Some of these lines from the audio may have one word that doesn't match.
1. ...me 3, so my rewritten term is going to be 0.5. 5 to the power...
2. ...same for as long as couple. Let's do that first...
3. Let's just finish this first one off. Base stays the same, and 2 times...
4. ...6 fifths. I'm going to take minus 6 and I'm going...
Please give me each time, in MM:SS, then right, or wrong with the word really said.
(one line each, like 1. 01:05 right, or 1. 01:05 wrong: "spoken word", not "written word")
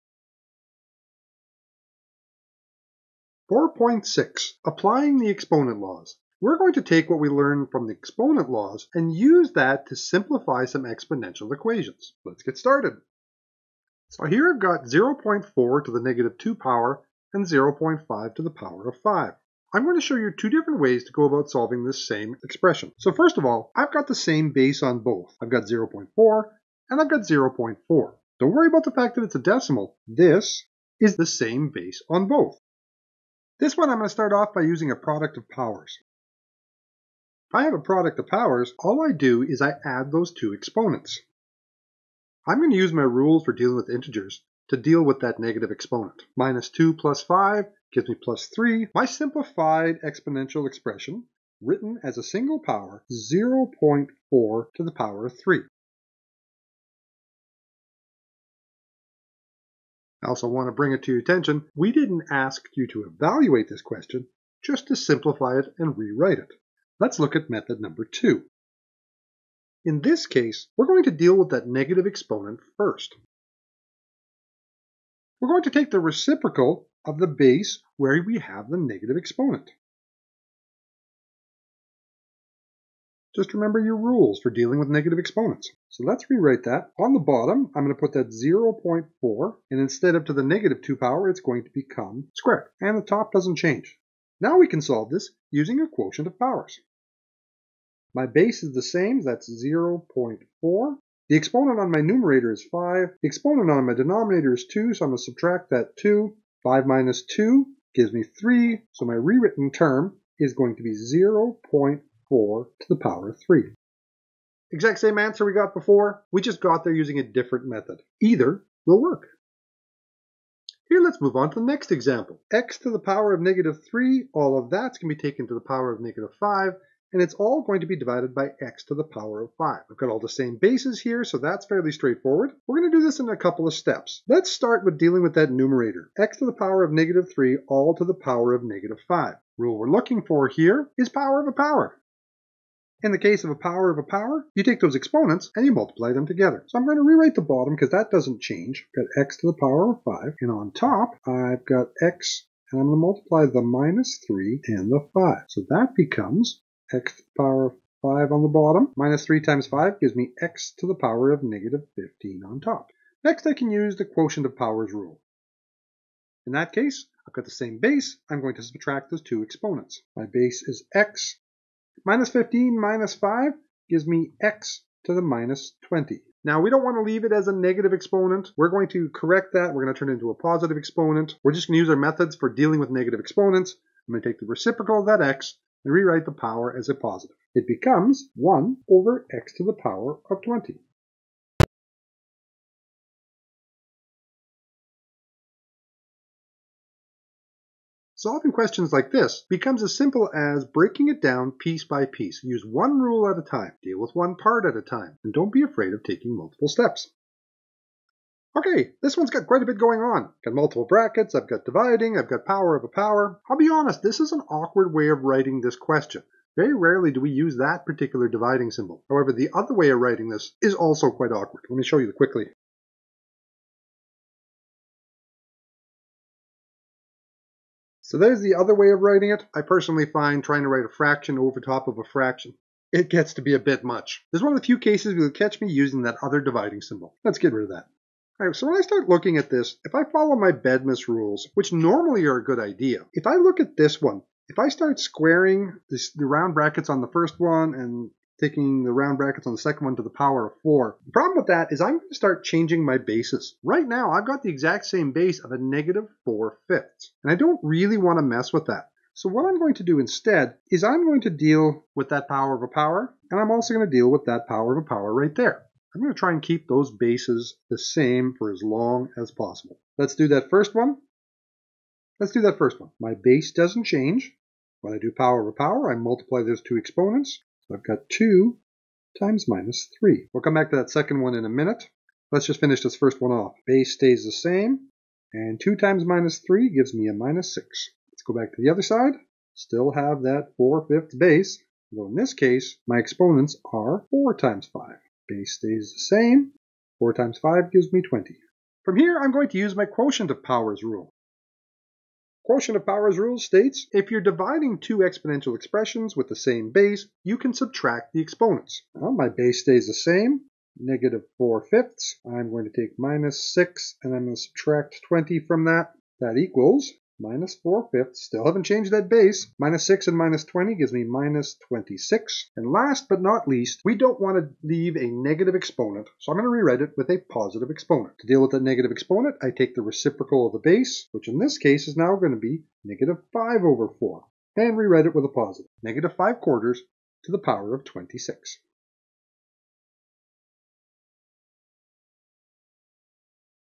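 1. 01:48 wrong: "4", not "5"
2. 04:27 wrong: "possible", not "couple"
3. 04:42 right
4. 05:11 wrong: "4", not "6".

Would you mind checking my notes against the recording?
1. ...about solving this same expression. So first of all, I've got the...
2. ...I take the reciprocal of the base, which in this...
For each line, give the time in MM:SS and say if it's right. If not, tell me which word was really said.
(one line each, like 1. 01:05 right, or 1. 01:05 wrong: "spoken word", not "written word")
1. 00:21 right
2. 05:29 right.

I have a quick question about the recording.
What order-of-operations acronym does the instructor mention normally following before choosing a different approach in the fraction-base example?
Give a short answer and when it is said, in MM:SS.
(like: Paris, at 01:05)
BEDMAS, at 04:00.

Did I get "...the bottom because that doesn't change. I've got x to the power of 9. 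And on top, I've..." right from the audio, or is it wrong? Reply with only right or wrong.
wrong.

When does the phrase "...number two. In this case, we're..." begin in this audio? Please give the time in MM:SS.
01:07.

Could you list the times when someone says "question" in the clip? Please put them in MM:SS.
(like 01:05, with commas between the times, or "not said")
01:03, 03:18, 03:35.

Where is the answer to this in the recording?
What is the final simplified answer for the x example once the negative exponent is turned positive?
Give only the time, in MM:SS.
03:08.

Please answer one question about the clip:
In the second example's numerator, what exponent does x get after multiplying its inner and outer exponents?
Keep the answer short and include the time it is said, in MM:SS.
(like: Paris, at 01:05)
-15, at 02:40.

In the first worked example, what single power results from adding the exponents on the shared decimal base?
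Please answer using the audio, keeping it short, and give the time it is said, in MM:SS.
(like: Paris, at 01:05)
0.4 to the power of 3, at 00:53.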